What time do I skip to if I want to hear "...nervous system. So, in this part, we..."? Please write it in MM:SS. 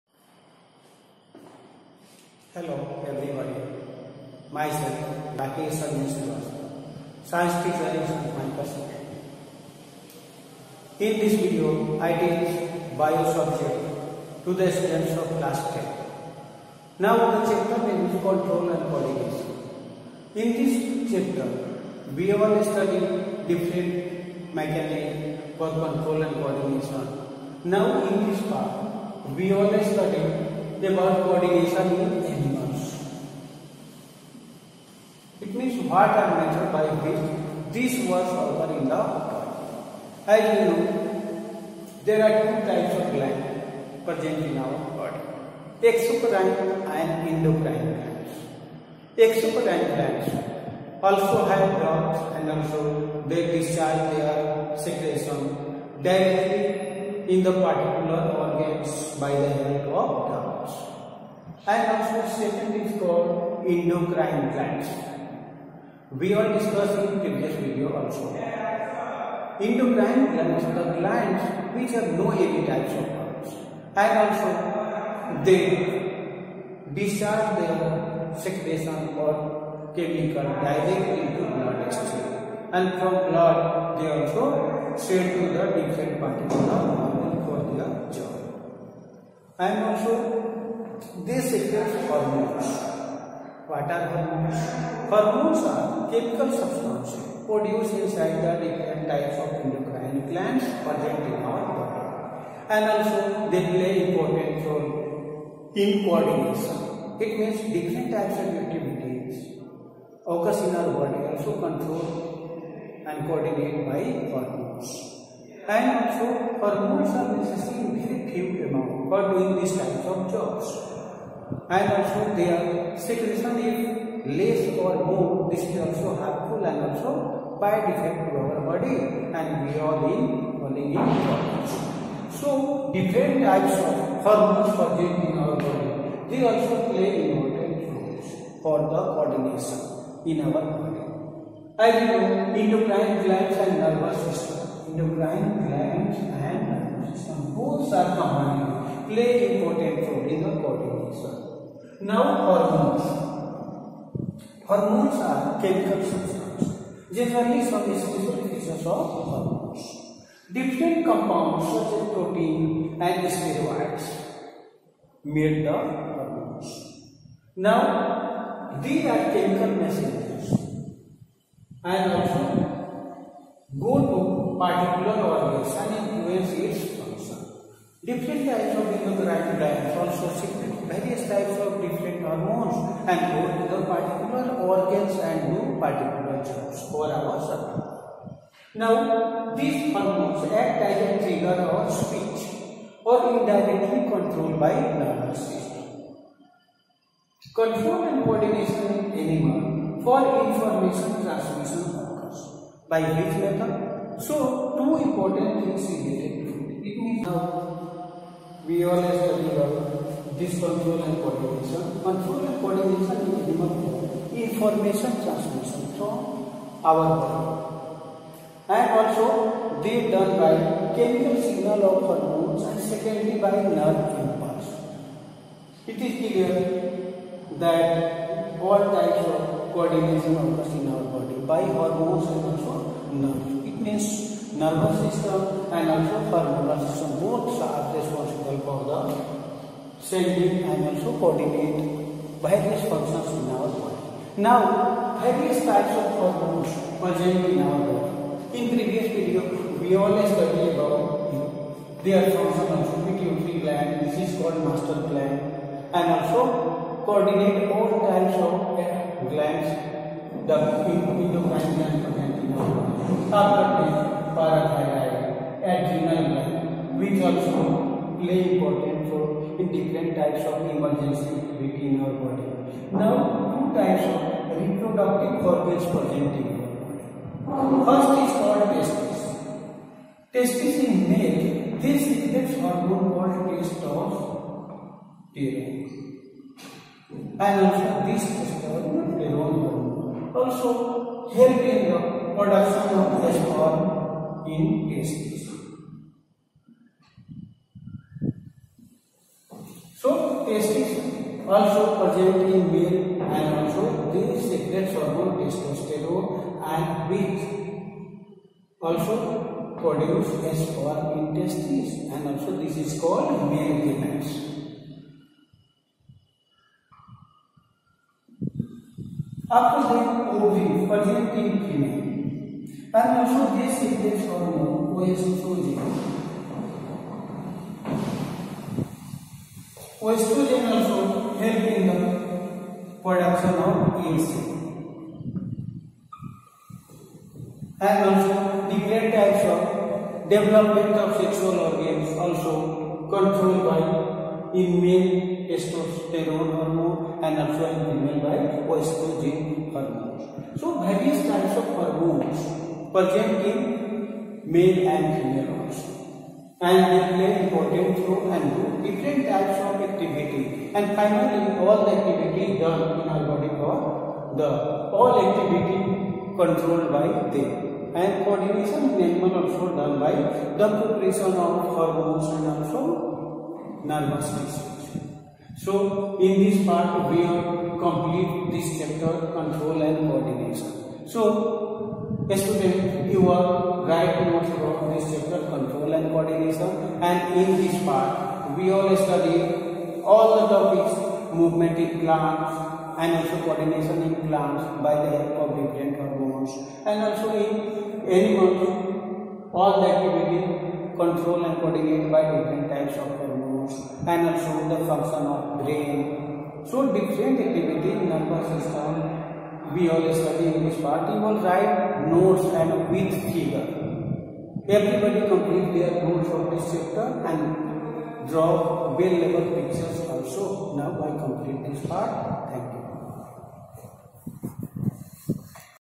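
06:13.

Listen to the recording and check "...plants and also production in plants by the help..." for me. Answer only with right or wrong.
wrong.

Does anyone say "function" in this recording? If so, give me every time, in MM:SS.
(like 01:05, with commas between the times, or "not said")
02:56, 04:02, 04:12, 06:44.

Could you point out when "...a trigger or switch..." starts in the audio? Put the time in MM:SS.
03:11.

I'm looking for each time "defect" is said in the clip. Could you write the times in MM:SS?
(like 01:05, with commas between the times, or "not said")
02:07.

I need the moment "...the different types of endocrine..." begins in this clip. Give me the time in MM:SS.
01:38.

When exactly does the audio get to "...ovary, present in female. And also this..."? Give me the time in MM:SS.
05:20.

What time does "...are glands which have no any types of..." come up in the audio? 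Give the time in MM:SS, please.
01:10.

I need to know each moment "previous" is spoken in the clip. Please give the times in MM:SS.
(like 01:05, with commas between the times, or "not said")
01:07, 04:08.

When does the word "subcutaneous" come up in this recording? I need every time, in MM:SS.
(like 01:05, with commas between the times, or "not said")
04:22.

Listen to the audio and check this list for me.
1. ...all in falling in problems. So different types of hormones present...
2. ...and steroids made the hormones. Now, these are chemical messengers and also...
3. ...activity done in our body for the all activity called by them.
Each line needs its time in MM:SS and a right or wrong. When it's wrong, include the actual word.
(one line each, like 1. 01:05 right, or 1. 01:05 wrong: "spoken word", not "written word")
1. 02:09 right
2. 02:43 right
3. 06:01 wrong: "controlled", not "called".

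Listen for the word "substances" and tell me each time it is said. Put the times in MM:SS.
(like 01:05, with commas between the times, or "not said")
01:36, 02:36.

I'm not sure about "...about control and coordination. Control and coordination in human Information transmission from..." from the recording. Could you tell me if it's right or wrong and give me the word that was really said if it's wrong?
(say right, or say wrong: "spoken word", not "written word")
right.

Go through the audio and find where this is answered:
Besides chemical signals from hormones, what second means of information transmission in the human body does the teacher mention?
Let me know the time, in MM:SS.
03:43.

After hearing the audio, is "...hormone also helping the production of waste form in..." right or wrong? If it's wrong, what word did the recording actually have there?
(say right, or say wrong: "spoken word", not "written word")
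wrong: "testosterone", not "hormone".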